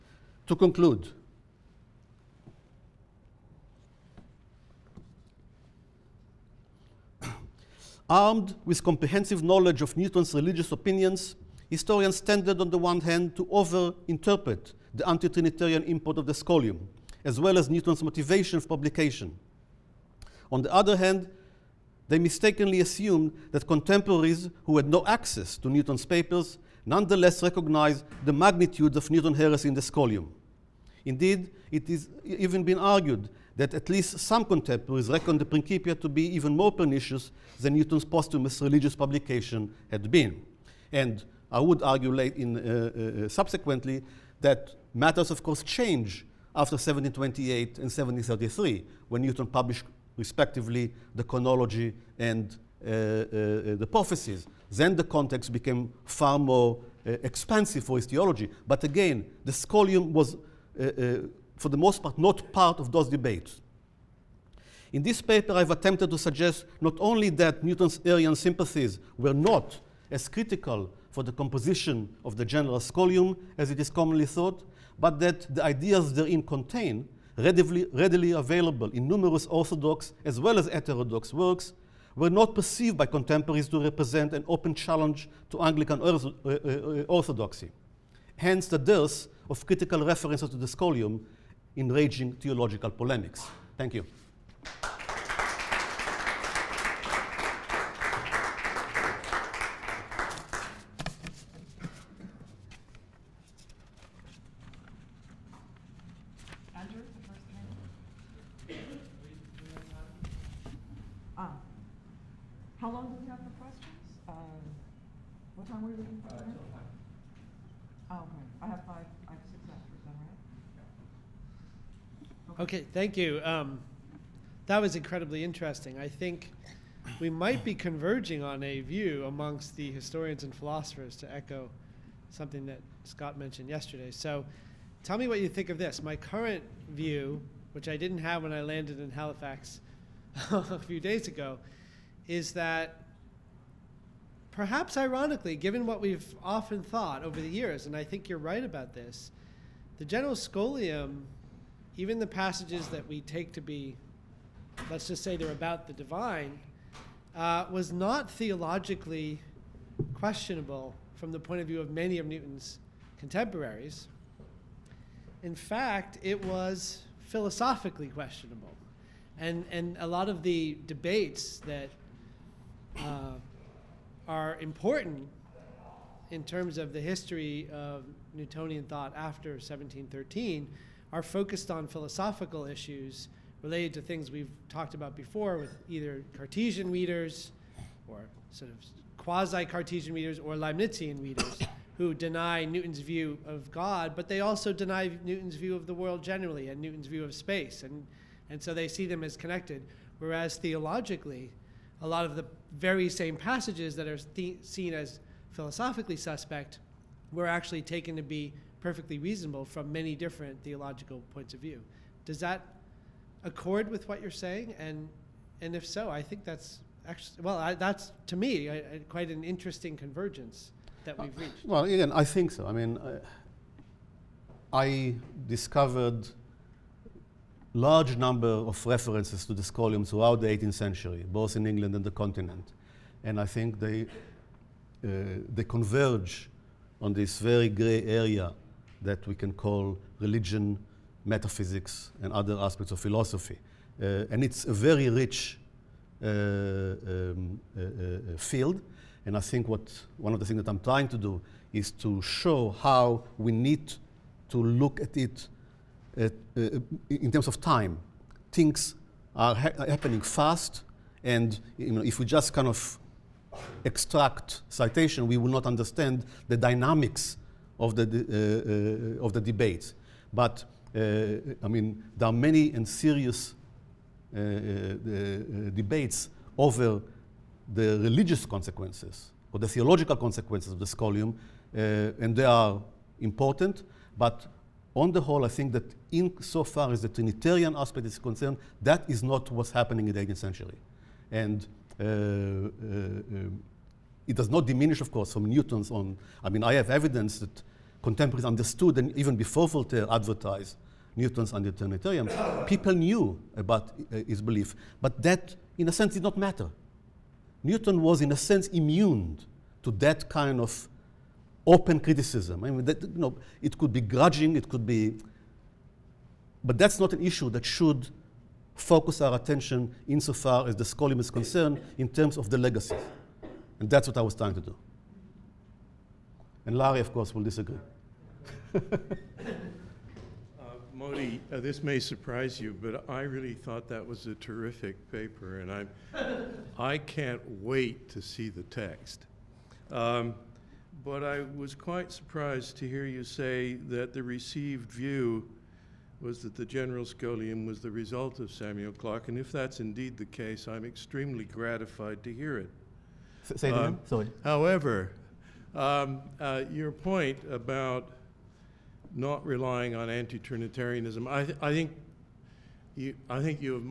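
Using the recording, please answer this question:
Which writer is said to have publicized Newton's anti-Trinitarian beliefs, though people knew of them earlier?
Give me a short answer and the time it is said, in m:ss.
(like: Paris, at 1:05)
Voltaire, at 4:59.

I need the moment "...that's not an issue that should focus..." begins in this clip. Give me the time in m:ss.
5:16.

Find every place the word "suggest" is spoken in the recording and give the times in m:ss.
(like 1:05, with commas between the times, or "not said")
1:06.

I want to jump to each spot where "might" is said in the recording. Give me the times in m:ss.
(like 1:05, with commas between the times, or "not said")
2:07.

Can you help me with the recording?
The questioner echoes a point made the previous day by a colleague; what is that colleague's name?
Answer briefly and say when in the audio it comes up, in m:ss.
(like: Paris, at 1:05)
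Scott, at 2:13.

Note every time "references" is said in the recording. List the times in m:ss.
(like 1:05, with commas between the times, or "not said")
1:30, 3:48.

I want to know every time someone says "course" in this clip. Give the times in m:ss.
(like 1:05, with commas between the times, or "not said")
0:45, 4:55, 5:27.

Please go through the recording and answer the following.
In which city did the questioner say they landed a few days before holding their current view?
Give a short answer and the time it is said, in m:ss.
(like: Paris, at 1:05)
Halifax, at 2:19.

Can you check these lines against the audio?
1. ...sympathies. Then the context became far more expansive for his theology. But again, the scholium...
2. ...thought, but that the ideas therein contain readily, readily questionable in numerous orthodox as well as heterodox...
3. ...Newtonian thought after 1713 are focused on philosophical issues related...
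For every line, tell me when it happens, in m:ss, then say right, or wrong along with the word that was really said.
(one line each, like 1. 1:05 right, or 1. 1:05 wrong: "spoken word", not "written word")
1. 0:53 wrong: "prophecies", not "sympathies"
2. 1:14 wrong: "available", not "questionable"
3. 2:58 right.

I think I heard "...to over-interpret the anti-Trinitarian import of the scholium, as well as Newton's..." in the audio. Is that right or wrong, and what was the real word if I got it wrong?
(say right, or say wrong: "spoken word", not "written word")
right.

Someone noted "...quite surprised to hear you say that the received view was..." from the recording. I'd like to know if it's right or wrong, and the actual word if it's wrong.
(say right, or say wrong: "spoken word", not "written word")
right.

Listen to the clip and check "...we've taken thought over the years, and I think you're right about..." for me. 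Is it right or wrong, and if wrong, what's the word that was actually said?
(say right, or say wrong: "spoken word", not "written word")
wrong: "often", not "taken".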